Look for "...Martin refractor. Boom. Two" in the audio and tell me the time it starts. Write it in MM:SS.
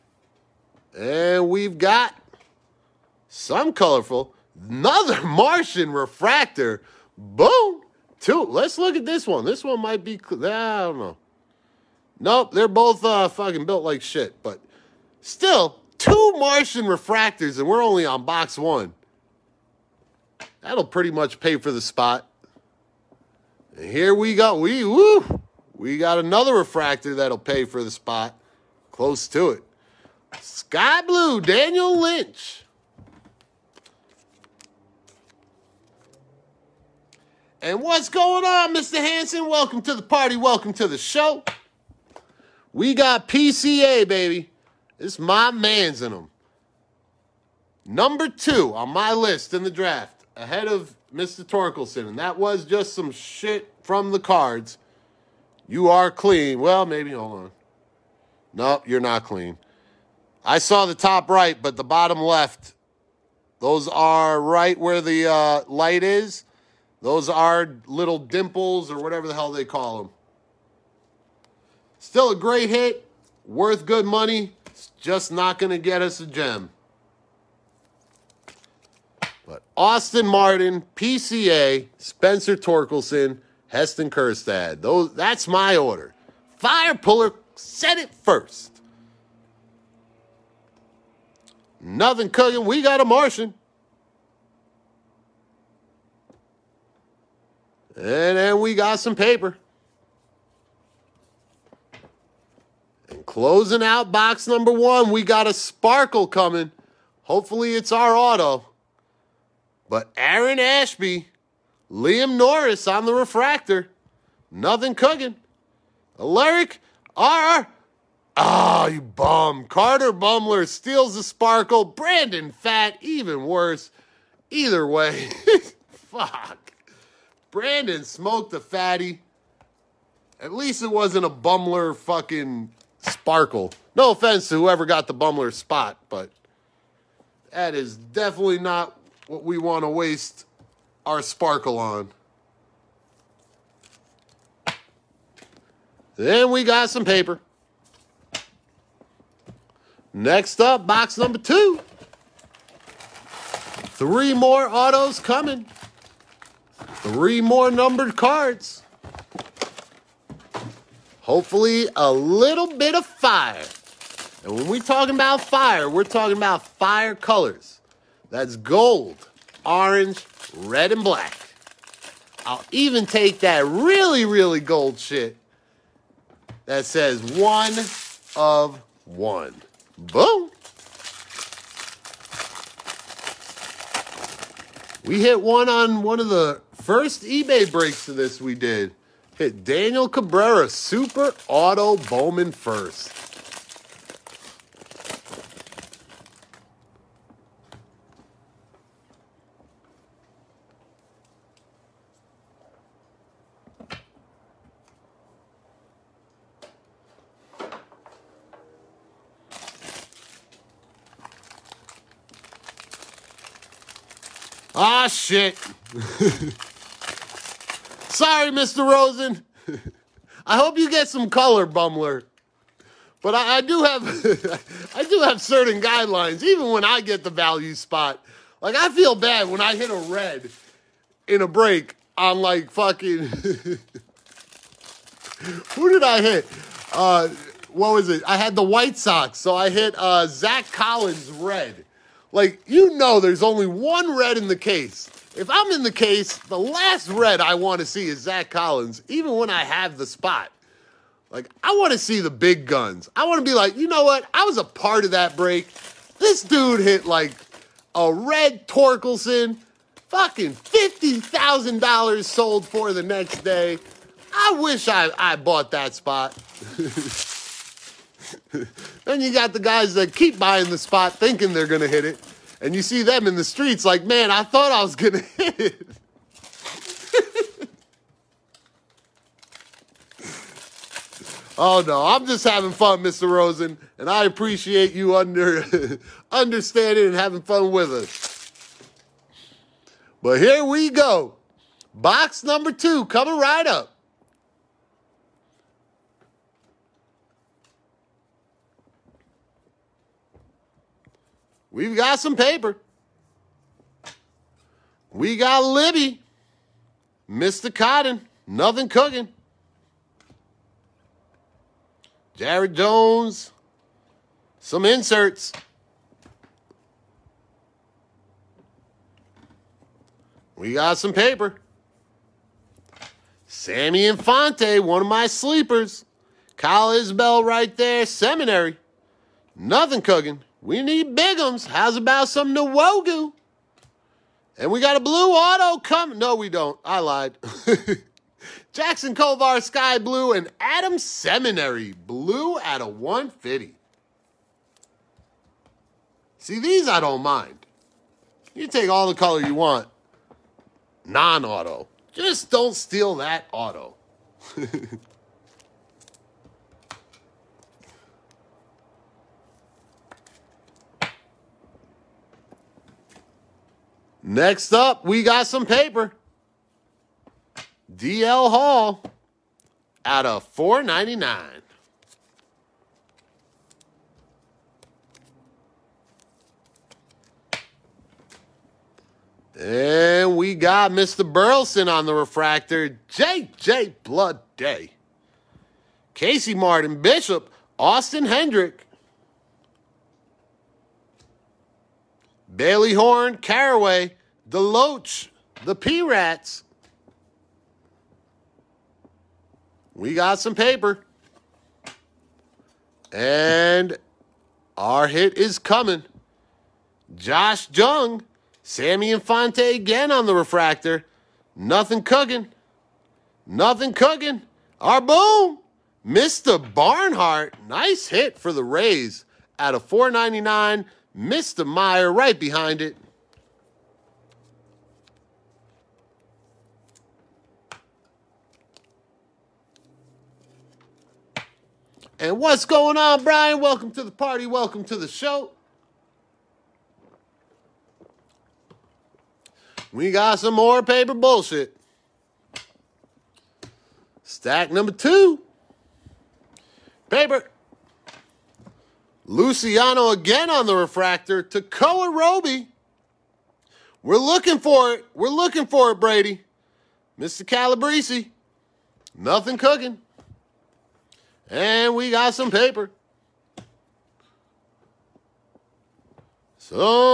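00:05.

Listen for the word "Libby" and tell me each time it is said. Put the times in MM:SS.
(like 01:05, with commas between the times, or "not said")
05:05.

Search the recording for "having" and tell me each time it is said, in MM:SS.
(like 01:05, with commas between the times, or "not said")
04:42, 04:47.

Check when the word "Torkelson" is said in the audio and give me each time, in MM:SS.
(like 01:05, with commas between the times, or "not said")
00:51, 01:22, 04:18.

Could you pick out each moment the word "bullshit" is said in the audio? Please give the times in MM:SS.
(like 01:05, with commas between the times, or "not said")
07:21.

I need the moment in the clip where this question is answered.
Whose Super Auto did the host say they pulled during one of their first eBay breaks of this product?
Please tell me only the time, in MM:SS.
03:09.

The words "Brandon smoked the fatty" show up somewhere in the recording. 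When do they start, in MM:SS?
02:07.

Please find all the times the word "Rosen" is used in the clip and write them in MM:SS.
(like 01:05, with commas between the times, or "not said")
03:38, 04:43.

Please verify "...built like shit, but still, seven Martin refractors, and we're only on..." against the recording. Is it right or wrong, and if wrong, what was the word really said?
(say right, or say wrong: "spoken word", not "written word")
wrong: "two", not "seven".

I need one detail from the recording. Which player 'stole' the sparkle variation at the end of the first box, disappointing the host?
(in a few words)
Carter Baumler.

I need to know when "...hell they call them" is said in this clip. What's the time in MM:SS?
01:09.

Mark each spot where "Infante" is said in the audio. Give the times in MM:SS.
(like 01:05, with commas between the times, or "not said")
05:24, 06:49.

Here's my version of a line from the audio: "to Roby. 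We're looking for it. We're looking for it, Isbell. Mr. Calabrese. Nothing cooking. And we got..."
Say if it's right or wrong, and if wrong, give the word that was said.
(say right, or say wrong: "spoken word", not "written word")
wrong: "Brady", not "Isbell".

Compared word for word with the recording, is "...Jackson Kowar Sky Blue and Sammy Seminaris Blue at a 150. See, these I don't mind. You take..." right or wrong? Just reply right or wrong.
wrong.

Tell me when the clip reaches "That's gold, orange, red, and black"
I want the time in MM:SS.
02:48.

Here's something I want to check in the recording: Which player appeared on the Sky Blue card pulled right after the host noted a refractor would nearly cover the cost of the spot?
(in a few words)
Daniel Lynch.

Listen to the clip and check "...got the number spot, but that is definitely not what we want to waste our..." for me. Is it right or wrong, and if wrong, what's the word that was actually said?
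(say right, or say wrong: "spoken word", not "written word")
wrong: "bumbler", not "number".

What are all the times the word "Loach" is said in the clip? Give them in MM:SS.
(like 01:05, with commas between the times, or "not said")
06:34.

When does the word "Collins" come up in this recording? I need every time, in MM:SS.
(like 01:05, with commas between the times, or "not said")
04:00, 04:08.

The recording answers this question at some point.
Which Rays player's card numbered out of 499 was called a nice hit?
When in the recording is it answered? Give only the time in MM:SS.
06:56.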